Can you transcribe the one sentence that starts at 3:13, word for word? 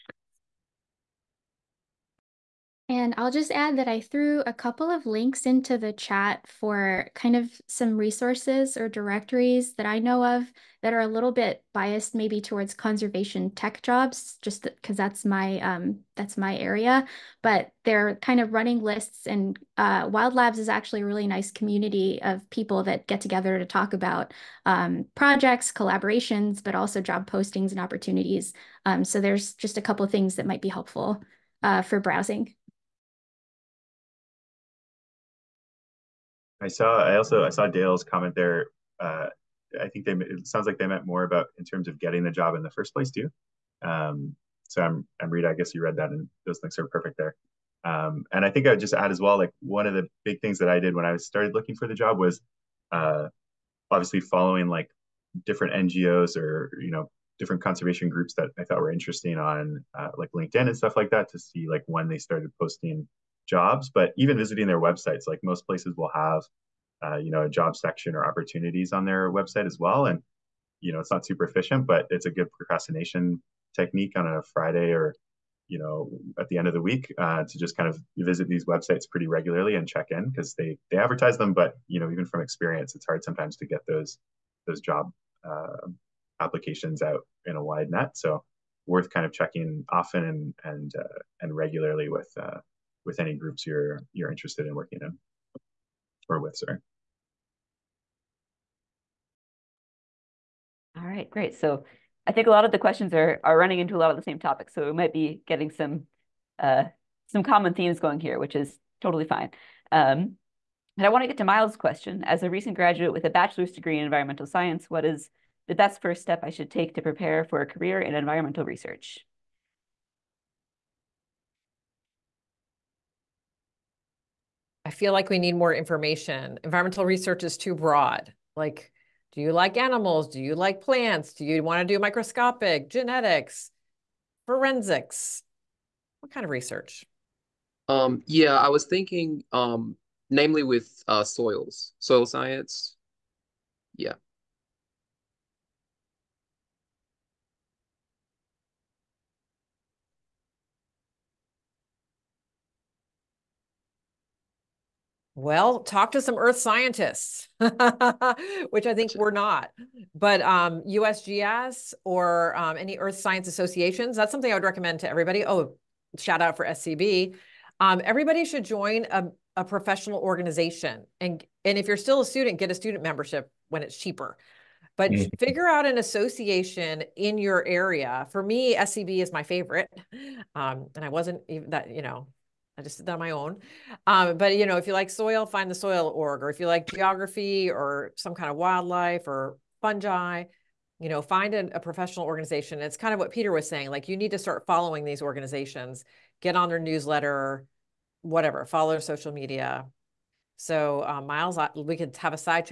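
Like you need to start following these organizations, get on their newsletter, whatever, follow their social media.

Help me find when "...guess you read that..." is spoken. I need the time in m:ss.
0:45.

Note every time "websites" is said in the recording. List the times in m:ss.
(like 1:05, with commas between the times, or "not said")
1:04, 1:09, 1:18.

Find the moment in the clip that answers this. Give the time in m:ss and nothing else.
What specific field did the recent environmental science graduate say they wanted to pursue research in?
2:21.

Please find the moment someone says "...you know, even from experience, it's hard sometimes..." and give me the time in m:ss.
1:21.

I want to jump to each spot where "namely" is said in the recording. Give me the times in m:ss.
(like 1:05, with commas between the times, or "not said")
2:20.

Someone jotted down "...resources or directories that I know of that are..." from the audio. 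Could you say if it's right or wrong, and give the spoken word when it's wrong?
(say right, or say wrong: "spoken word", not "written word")
right.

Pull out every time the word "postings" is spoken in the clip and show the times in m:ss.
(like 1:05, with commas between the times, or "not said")
0:27, 1:02.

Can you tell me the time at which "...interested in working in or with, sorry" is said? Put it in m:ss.
1:34.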